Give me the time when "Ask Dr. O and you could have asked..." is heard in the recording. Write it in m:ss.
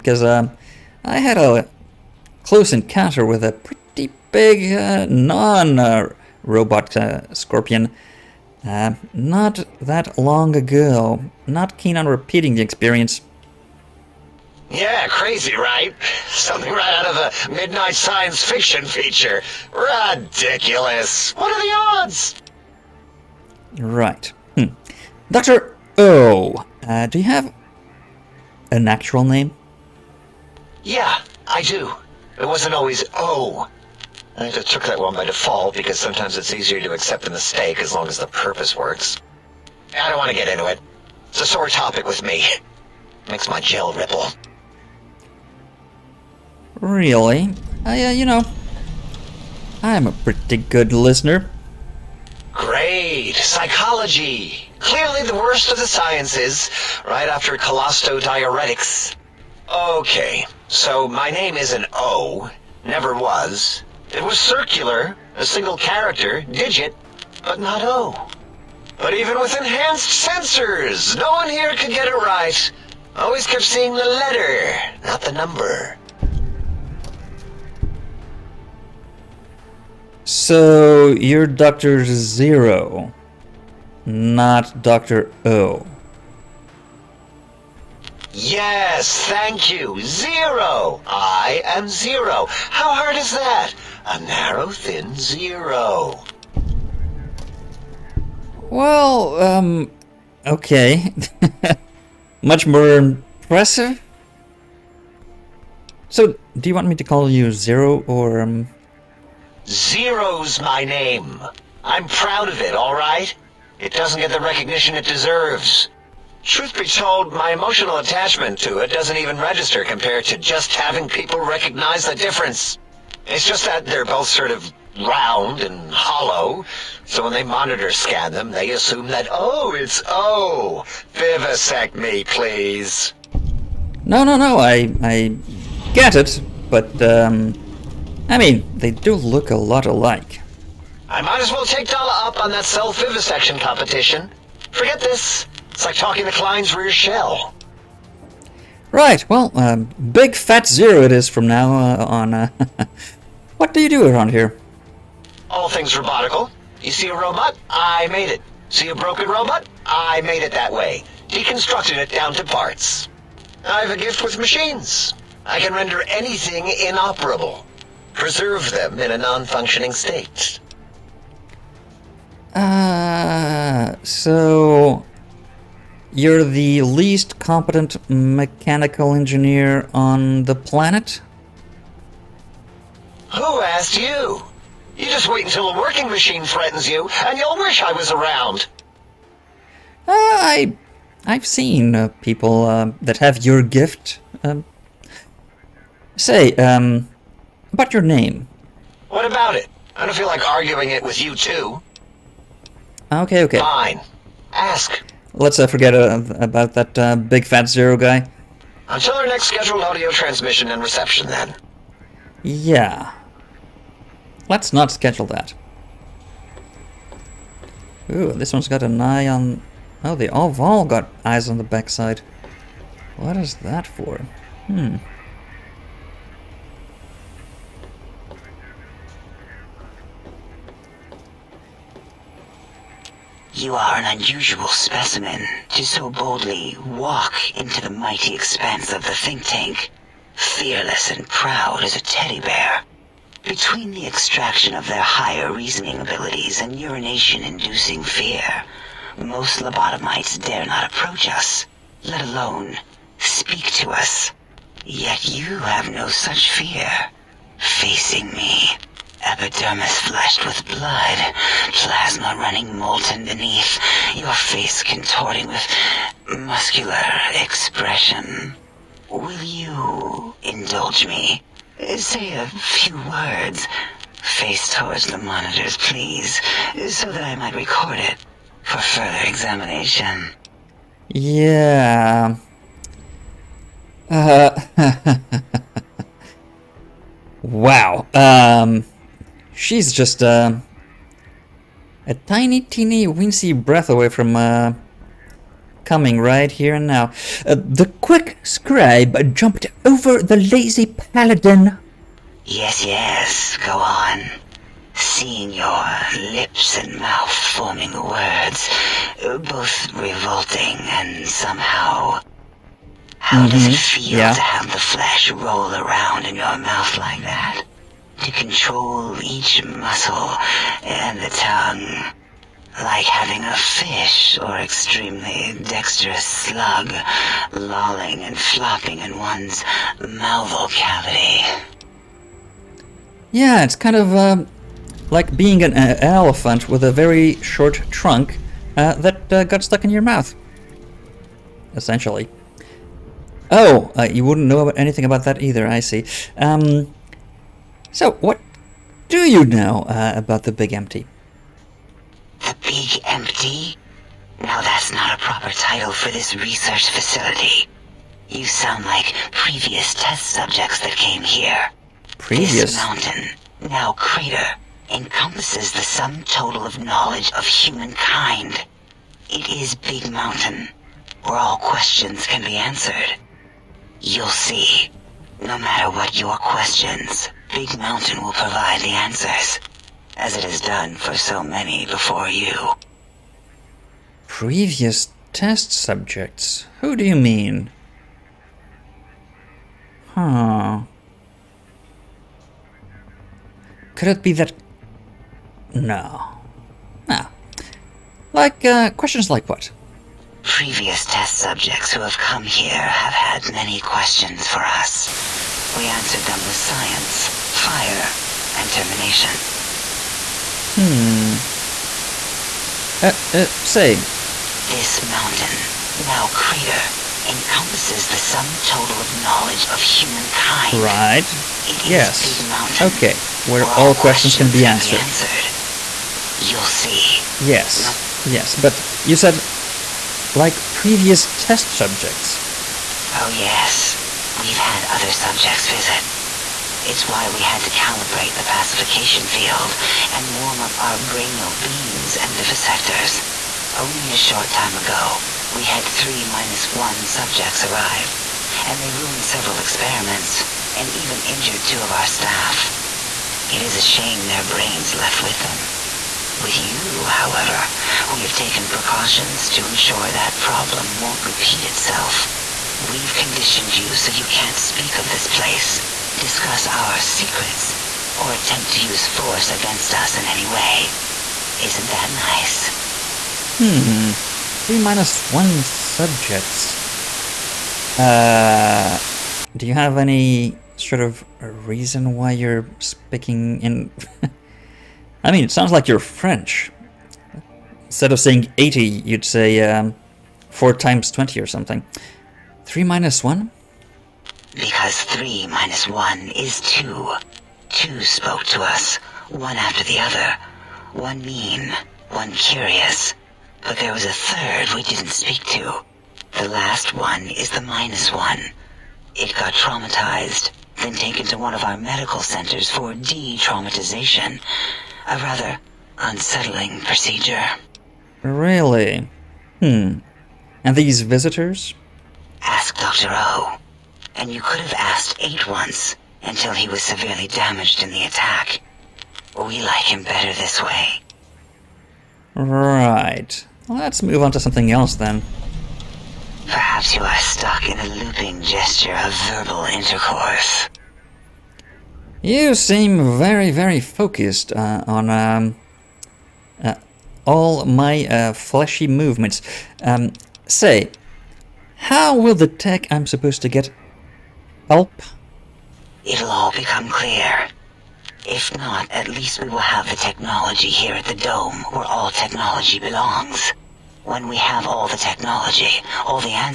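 8:42.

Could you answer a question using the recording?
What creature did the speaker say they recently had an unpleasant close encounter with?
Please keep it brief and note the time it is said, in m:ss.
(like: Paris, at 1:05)
Scorpion, at 0:07.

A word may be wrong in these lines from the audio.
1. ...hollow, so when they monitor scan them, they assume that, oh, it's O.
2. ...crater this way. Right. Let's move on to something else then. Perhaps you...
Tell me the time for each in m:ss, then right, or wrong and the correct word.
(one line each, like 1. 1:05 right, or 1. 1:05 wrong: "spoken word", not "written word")
1. 2:05 right
2. 8:50 wrong: "better", not "crater".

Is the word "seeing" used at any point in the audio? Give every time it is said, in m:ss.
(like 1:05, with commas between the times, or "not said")
1:13, 5:04.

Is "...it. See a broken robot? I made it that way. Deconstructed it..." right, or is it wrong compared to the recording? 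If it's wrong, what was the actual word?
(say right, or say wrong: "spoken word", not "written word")
right.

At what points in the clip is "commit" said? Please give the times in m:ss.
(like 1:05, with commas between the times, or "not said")
not said.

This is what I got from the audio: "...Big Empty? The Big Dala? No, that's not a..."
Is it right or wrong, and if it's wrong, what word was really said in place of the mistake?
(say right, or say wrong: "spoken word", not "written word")
wrong: "Empty", not "Dala".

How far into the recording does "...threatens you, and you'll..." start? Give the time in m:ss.
3:06.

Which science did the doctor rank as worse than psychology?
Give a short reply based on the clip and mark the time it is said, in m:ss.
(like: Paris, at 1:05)
Colostodiuretics, at 0:57.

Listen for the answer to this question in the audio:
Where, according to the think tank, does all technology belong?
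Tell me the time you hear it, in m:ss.
9:21.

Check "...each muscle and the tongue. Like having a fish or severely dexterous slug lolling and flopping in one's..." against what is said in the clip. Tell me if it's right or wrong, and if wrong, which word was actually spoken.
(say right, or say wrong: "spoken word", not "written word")
wrong: "extremely", not "severely".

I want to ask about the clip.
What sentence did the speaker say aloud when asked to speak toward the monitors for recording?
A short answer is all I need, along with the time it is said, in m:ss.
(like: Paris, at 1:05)
The quick scribe jumped over the lazy paladin, at 4:57.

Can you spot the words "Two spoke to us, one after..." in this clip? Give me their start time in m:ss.
8:17.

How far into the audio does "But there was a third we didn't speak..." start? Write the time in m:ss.
8:23.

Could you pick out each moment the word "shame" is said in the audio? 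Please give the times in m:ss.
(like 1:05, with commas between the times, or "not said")
7:33.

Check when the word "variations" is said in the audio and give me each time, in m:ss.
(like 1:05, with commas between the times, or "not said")
not said.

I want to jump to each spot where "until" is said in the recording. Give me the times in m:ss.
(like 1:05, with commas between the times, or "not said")
3:05, 3:28, 8:46.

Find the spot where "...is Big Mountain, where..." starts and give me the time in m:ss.
6:09.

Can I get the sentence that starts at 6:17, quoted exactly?
Big Mountain will provide the answers, as it has done for so many before you.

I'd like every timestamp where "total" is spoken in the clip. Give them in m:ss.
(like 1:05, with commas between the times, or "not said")
6:06, 6:58.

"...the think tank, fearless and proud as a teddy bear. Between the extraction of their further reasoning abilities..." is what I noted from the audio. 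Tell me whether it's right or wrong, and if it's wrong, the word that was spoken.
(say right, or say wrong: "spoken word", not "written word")
wrong: "higher", not "further".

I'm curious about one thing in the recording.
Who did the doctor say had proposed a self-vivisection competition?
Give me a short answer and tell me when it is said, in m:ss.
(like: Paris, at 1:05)
Dala, at 2:21.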